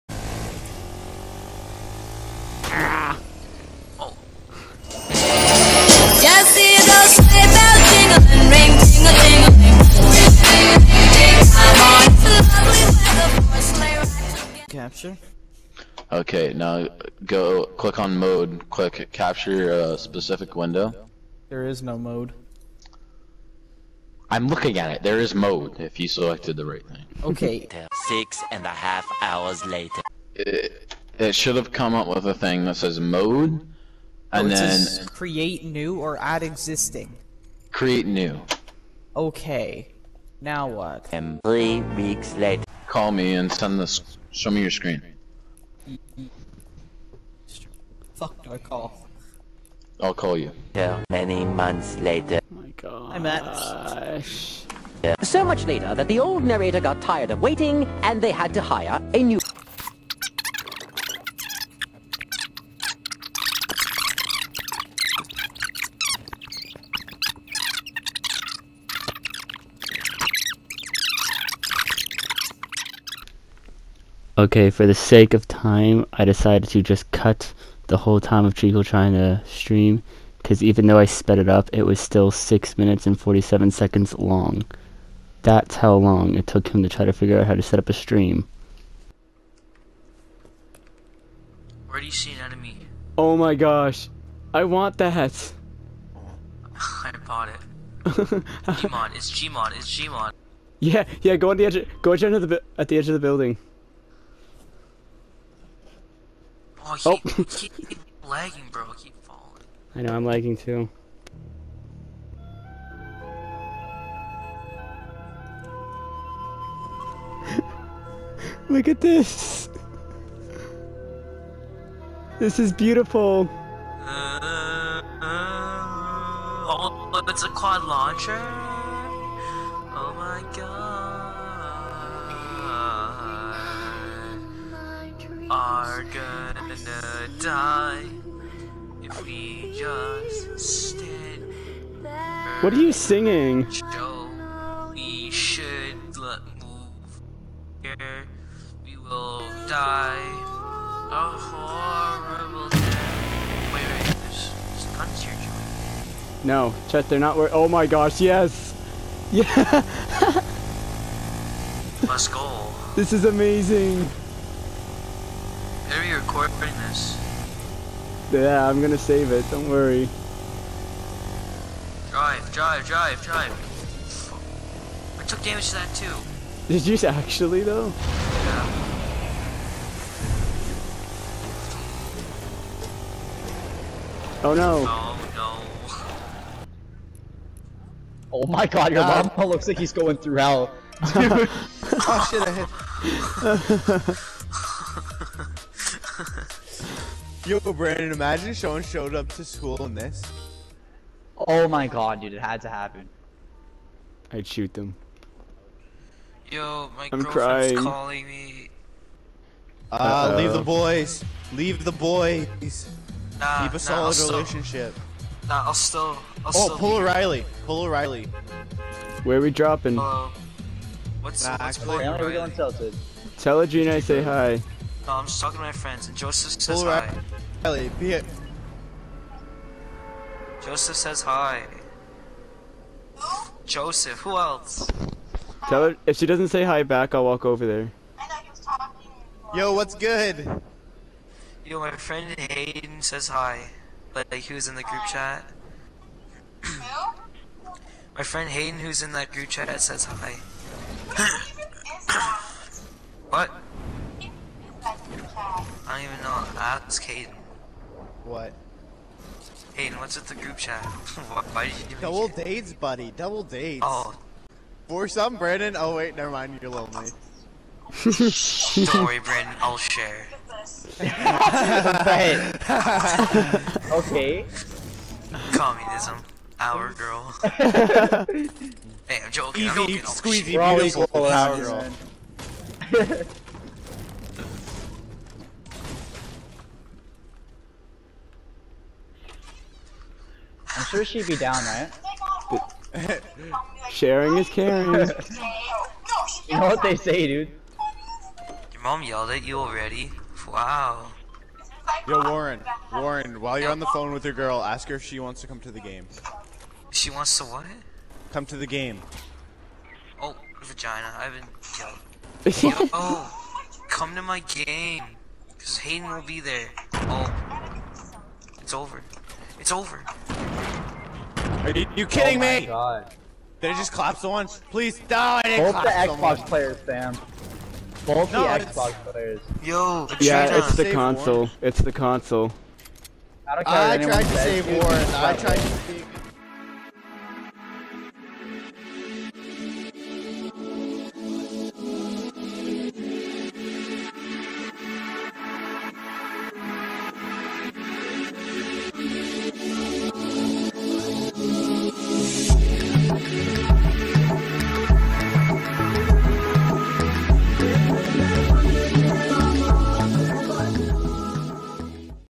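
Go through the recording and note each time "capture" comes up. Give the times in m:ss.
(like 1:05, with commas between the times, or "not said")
0:15, 0:19.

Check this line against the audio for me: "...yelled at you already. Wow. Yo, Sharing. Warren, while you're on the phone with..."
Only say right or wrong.
wrong.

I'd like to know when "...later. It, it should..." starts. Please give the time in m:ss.
0:29.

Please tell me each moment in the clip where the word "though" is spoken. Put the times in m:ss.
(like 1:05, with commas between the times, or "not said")
1:20, 2:57.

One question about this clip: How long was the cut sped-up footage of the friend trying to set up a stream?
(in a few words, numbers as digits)
6 minutes and 47 seconds.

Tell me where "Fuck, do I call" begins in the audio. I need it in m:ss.
0:48.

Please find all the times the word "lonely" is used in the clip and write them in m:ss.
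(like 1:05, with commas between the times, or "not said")
4:26.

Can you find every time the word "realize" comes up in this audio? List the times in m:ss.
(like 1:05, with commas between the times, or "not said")
not said.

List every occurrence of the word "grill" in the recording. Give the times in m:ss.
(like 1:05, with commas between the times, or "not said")
not said.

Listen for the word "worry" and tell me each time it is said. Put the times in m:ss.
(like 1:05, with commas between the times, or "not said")
2:49, 4:29.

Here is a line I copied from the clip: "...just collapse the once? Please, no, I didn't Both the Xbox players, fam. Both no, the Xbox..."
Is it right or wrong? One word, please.
right.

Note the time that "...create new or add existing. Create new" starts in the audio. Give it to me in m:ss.
0:35.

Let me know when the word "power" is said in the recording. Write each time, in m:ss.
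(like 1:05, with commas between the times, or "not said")
4:41.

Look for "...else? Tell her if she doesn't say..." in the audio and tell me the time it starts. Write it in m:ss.
3:54.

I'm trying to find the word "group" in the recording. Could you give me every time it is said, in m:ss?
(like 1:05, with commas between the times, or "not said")
4:04, 4:09, 4:20.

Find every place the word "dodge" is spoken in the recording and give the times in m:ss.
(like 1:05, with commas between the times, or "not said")
not said.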